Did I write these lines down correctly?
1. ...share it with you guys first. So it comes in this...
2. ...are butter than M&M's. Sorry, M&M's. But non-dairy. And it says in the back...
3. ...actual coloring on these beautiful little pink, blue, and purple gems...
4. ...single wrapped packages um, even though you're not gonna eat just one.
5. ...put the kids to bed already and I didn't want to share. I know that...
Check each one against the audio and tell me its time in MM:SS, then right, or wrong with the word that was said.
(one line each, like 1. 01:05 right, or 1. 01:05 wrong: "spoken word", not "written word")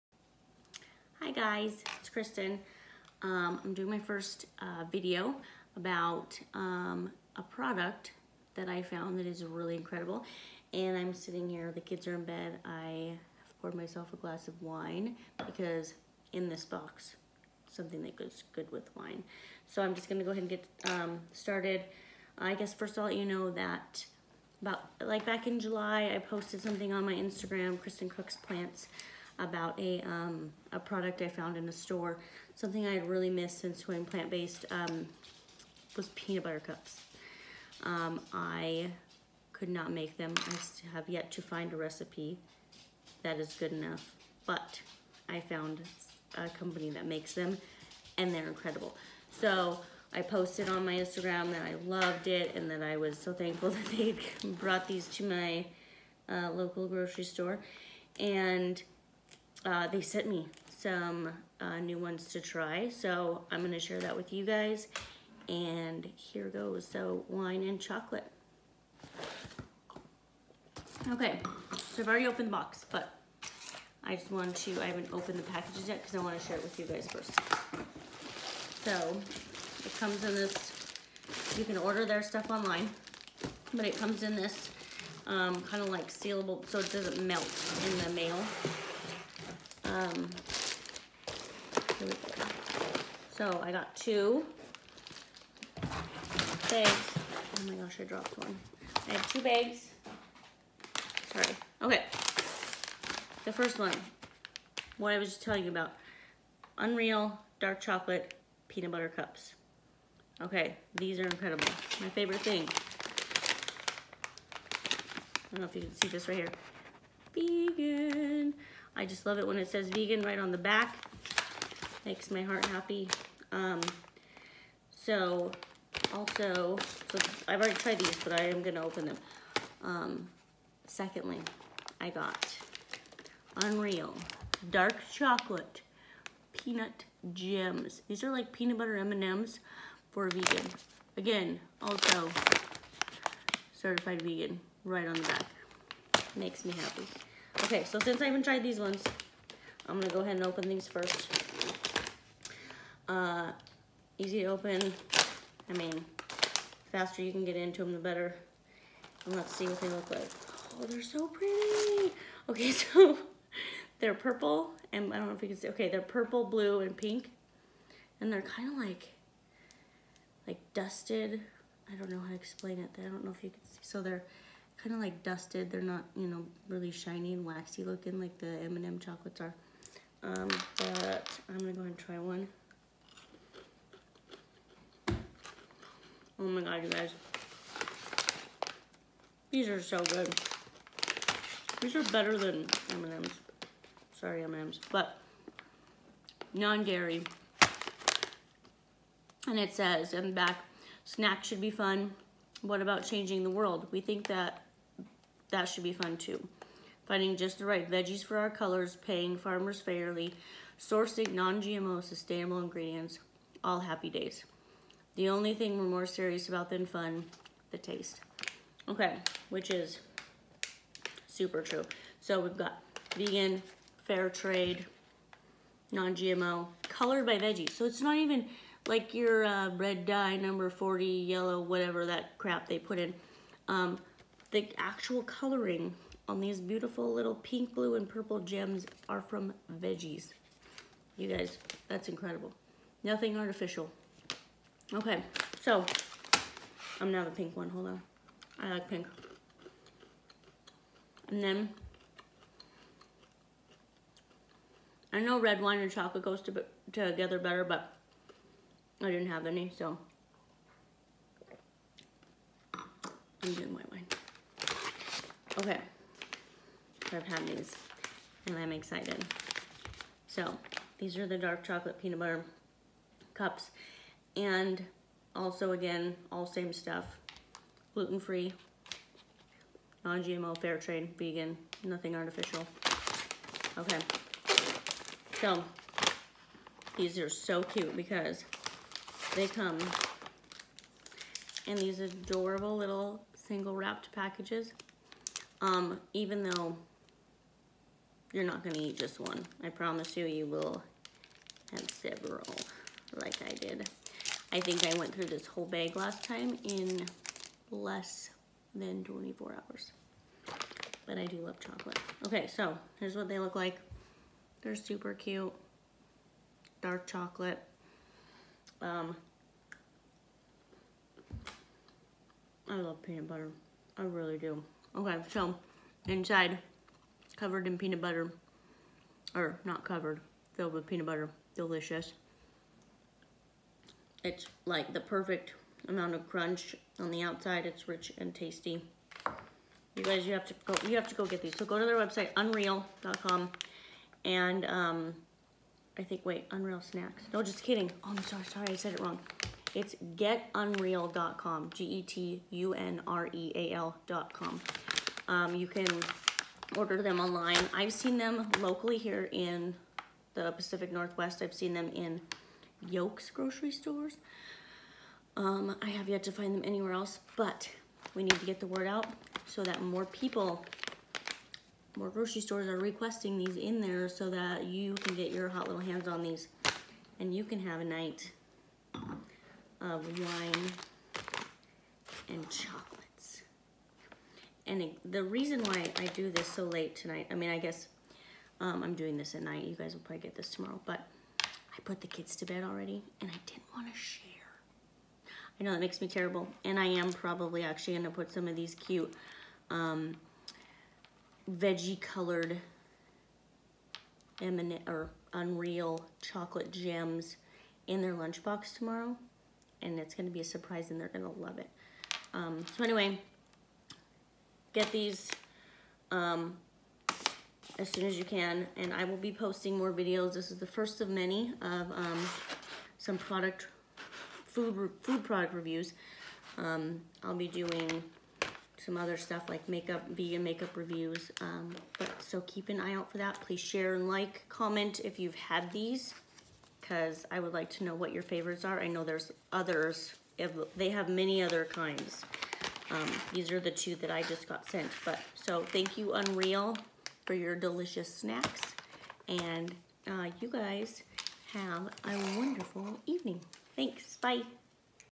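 1. 01:16 right
2. 03:11 wrong: "better", not "butter"
3. 03:54 right
4. 04:53 right
5. 06:31 right.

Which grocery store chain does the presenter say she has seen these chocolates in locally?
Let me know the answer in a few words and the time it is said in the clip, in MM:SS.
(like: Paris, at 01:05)
Yoke's, at 06:02.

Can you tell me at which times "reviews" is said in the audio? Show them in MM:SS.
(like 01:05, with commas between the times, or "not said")
07:05, 07:10.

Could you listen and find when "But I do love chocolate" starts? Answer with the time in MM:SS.
05:11.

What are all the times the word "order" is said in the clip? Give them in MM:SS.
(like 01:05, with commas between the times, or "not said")
01:21, 05:56.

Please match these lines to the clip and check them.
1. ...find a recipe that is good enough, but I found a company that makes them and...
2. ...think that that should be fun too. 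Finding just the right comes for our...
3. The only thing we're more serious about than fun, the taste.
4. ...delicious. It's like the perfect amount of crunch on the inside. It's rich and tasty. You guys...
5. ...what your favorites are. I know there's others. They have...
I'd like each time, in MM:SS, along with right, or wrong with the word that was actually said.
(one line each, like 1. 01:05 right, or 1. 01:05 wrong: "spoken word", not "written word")
1. 00:41 right
2. 03:24 wrong: "veggies", not "comes"
3. 03:35 right
4. 05:31 wrong: "outside", not "inside"
5. 07:17 right.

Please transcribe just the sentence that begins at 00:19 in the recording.
So I'm just gonna go ahead and get um, started.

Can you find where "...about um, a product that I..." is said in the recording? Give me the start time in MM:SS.
00:05.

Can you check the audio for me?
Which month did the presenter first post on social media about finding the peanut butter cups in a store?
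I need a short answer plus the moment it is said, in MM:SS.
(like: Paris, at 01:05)
July, at 00:25.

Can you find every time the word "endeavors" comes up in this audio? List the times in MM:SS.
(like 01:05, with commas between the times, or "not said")
not said.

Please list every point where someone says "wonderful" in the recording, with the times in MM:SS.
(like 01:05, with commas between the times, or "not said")
07:32.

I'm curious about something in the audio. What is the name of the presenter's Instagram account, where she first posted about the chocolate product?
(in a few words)
Kristin Cooks Plants.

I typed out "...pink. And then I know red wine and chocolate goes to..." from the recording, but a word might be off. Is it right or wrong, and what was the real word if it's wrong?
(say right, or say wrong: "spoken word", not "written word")
right.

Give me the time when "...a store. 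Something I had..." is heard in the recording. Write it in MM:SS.
00:31.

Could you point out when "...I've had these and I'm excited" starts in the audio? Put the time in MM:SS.
04:27.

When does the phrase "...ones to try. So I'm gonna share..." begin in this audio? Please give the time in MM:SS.
01:01.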